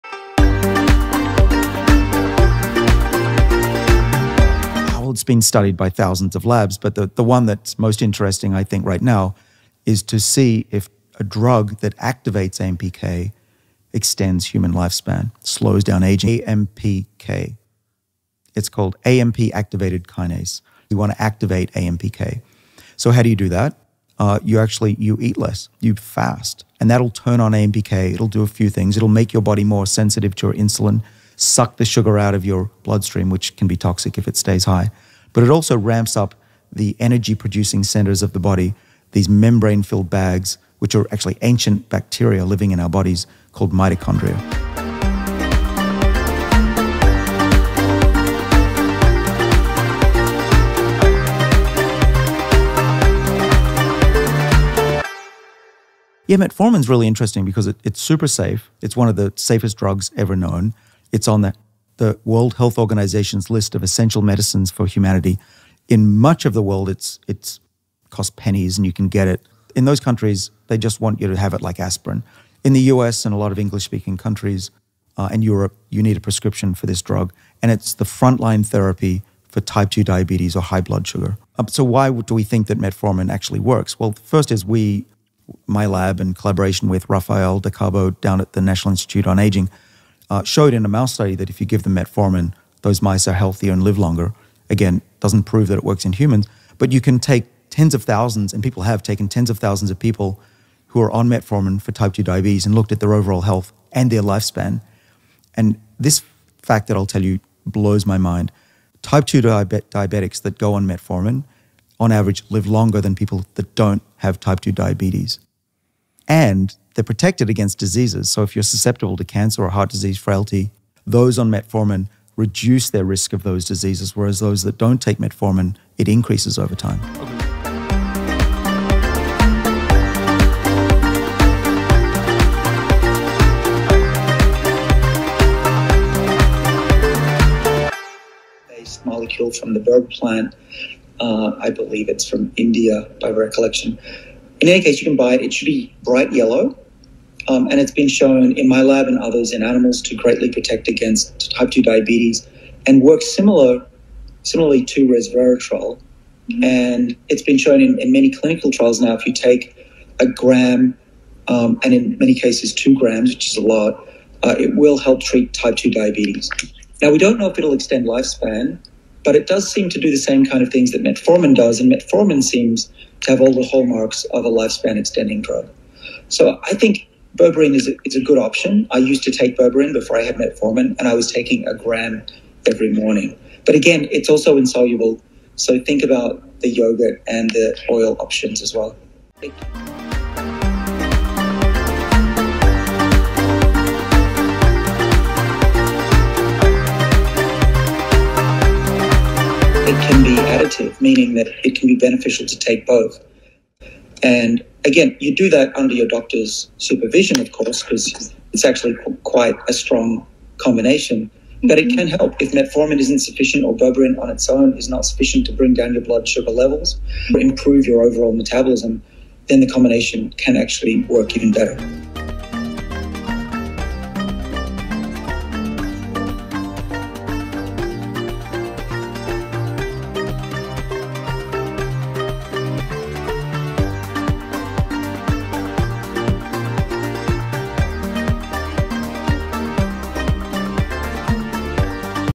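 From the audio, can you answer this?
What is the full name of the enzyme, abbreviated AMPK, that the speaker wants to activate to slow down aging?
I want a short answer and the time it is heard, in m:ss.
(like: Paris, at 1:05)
AMP activated kinase, at 0:19.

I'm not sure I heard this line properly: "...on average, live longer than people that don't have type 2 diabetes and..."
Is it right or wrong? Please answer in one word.
right.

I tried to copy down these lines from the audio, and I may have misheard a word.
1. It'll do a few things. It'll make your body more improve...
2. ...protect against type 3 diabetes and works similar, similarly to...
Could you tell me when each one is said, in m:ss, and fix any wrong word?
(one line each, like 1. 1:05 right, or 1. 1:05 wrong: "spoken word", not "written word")
1. 0:28 wrong: "sensitive", not "improve"
2. 2:30 wrong: "2", not "3".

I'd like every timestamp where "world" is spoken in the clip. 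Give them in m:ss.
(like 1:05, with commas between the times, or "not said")
1:02, 1:06.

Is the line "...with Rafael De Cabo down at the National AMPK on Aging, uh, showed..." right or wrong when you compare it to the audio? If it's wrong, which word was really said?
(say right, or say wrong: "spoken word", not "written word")
wrong: "Institute", not "AMPK".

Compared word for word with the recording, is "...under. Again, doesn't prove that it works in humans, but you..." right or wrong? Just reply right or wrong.
wrong.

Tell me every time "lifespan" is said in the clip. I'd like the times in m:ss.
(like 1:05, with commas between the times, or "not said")
0:14, 1:44, 2:48, 2:54.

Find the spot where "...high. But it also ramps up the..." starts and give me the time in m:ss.
0:34.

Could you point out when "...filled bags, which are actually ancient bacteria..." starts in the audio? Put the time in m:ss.
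0:39.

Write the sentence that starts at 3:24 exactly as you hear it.
And again, you do that under your doctor's supervision, of course, because it's actually quite a strong combination.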